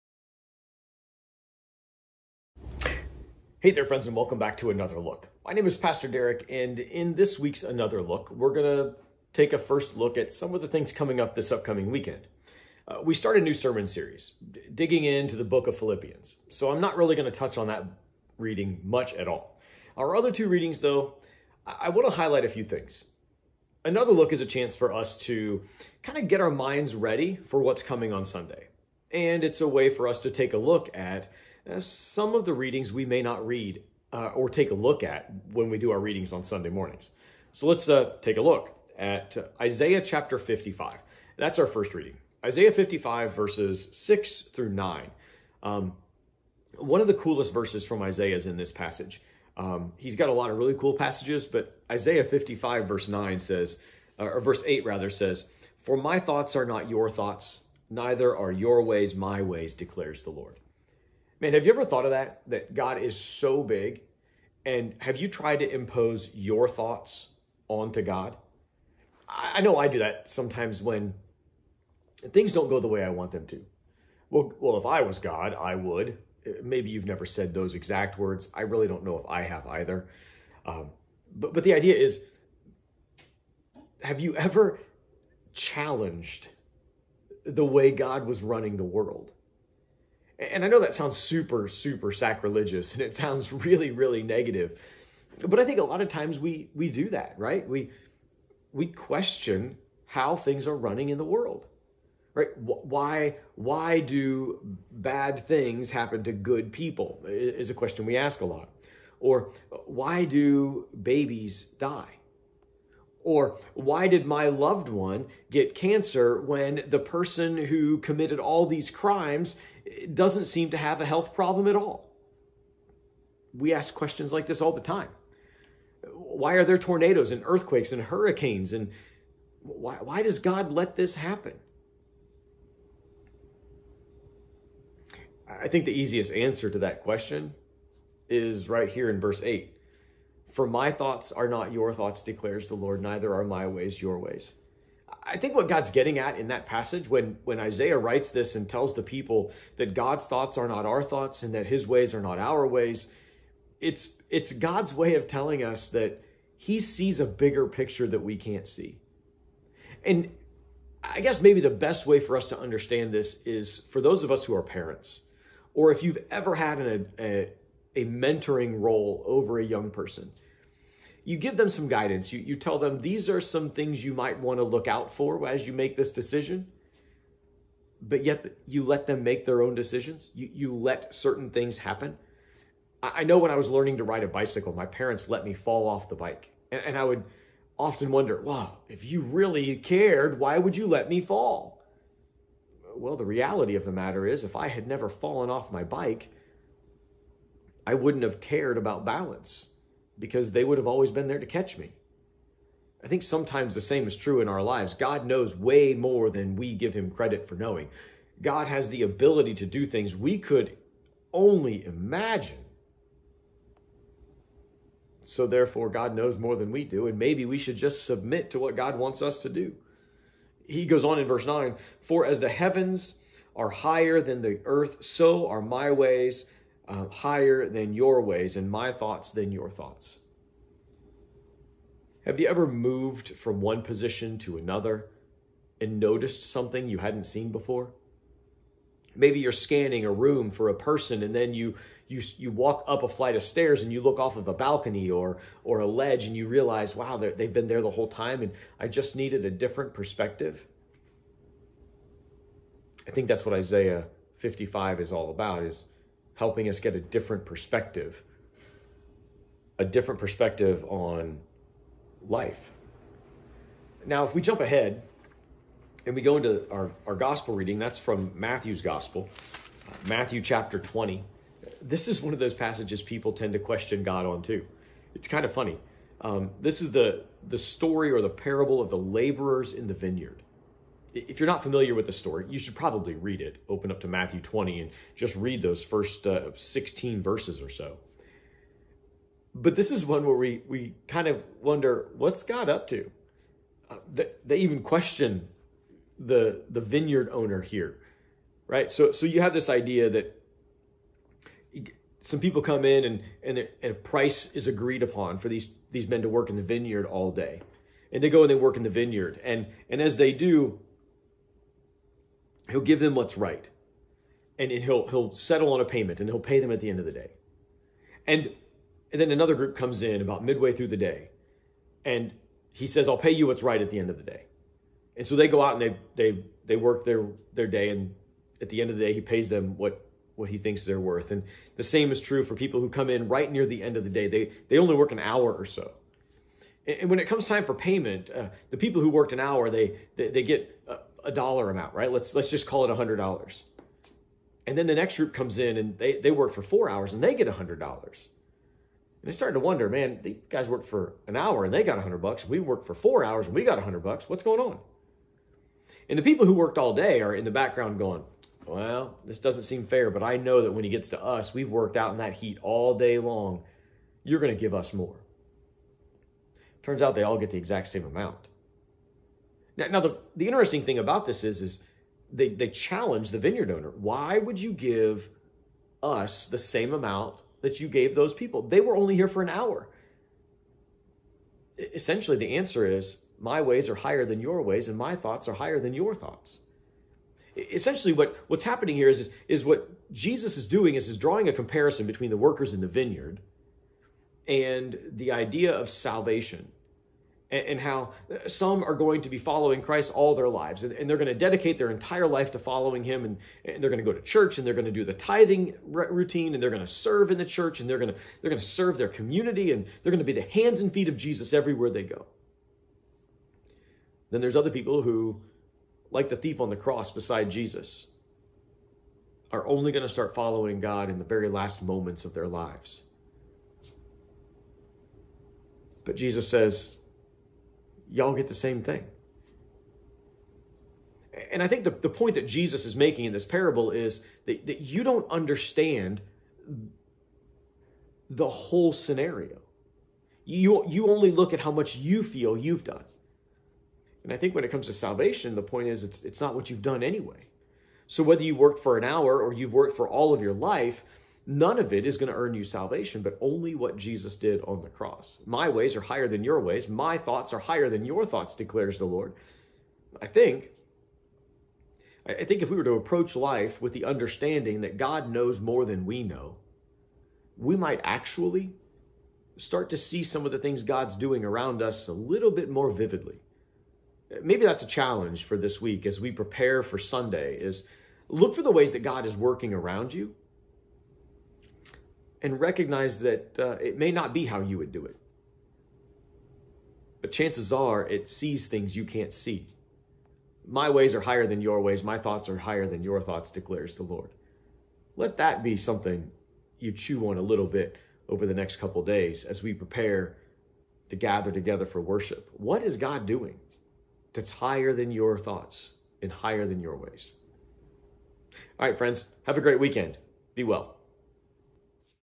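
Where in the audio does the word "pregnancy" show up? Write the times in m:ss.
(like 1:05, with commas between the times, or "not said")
not said.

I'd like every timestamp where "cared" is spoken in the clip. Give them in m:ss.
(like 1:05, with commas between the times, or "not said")
3:09, 3:18.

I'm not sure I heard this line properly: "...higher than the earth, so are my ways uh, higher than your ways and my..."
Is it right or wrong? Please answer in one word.
right.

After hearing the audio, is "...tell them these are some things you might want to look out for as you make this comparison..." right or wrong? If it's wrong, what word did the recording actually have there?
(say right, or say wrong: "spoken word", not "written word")
wrong: "decision", not "comparison".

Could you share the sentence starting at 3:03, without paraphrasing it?
I, I know when I was learning to ride a bicycle, my parents let me fall off the bike.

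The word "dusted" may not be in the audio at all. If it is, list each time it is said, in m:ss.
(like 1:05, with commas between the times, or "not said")
not said.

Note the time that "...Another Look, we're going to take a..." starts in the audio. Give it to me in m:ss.
0:07.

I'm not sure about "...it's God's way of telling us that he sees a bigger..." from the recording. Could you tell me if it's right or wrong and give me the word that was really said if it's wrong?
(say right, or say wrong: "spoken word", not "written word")
right.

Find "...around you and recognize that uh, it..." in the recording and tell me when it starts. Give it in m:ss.
7:59.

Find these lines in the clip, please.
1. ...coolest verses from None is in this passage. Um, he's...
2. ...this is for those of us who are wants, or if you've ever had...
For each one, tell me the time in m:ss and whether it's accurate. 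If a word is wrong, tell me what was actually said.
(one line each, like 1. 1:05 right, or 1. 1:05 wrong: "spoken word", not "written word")
1. 0:47 wrong: "Isaiah", not "None"
2. 2:43 wrong: "parents", not "wants".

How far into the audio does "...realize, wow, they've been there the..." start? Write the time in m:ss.
4:06.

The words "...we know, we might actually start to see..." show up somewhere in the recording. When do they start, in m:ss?
7:46.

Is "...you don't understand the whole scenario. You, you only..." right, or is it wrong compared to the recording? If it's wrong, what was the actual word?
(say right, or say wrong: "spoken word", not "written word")
right.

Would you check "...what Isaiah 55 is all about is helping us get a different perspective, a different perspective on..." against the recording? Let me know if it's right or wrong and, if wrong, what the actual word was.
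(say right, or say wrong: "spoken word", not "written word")
right.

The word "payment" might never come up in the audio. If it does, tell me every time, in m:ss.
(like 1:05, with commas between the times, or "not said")
5:15, 5:37.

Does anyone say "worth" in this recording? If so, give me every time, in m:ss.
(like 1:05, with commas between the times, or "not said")
5:30.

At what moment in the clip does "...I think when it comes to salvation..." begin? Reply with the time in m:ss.
7:24.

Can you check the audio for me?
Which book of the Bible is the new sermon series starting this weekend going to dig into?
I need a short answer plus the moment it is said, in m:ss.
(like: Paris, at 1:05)
Philippians, at 0:15.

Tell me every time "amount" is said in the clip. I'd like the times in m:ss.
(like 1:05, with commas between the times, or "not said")
5:41, 6:08, 6:16.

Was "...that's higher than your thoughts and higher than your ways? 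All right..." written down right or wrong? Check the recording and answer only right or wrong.
right.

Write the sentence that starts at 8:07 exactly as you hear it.
But chances are it sees things you can't see.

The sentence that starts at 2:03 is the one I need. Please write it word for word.
We ask questions like this all the time.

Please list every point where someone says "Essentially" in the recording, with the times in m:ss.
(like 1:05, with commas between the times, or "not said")
6:21, 6:27.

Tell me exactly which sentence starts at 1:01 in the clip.
Man, have you ever thought of that?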